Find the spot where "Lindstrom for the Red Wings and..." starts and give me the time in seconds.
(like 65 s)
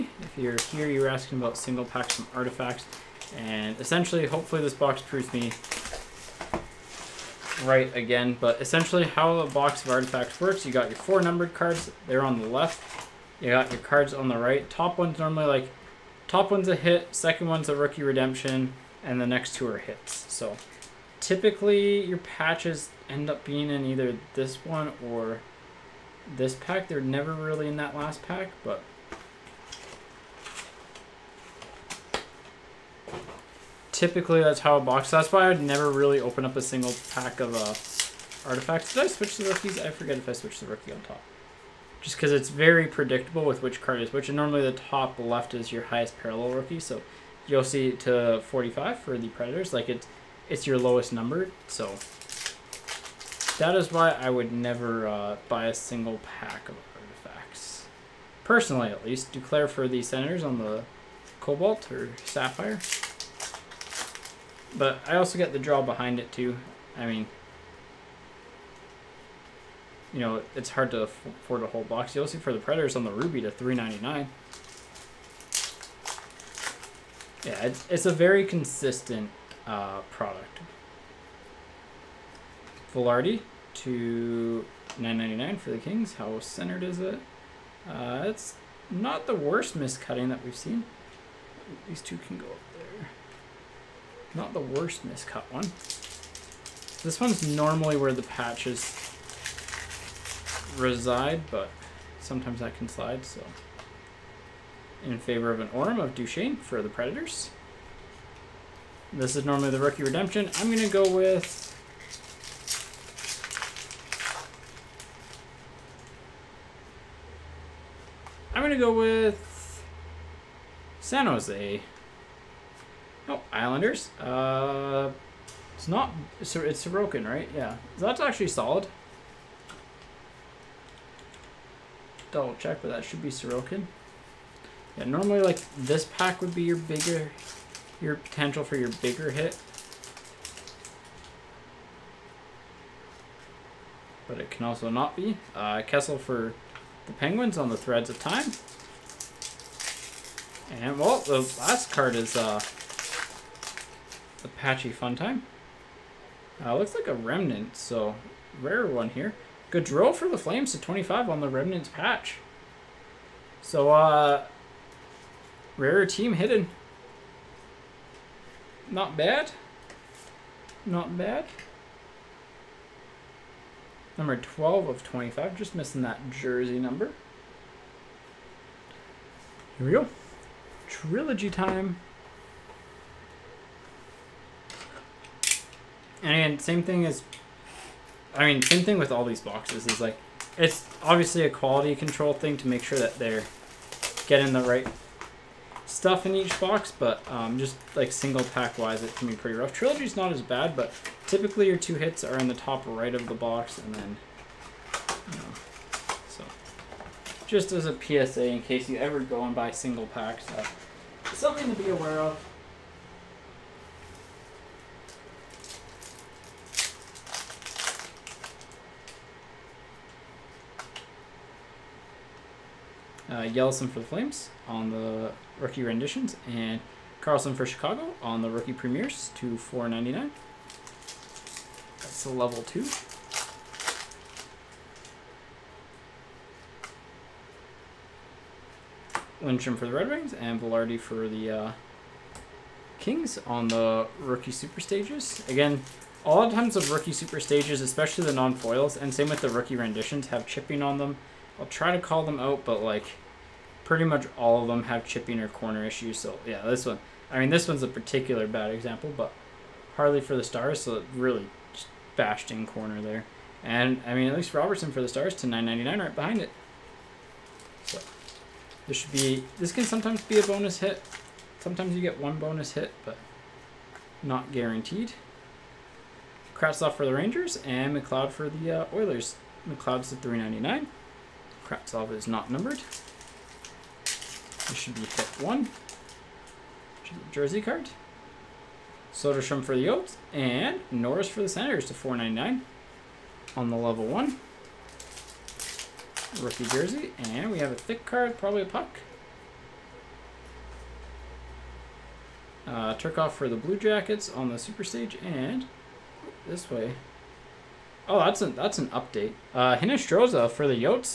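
239 s.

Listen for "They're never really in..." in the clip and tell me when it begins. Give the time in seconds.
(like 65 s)
26 s.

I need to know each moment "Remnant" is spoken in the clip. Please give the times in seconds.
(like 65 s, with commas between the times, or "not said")
157 s, 161 s.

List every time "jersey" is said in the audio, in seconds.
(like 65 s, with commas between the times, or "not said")
176 s, 287 s, 296 s.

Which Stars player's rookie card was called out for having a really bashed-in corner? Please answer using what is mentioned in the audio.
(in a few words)
Harley.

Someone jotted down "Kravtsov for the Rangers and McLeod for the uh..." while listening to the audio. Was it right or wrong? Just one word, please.
right.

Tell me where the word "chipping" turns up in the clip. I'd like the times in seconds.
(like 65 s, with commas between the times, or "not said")
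250 s, 255 s.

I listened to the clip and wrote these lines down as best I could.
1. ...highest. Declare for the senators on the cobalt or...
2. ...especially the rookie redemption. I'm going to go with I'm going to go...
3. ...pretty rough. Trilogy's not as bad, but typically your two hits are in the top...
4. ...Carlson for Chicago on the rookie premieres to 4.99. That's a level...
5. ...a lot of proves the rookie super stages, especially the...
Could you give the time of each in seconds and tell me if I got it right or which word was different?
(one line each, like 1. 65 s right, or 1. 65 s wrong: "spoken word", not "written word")
1. 59 s wrong: "least", not "highest"
2. 109 s wrong: "normally", not "especially"
3. 199 s right
4. 227 s right
5. 246 s wrong: "times", not "proves".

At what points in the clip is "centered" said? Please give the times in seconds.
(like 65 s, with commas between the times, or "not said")
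86 s.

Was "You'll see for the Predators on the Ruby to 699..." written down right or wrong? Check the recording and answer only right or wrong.
wrong.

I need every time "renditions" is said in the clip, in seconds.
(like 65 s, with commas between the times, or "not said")
225 s, 249 s.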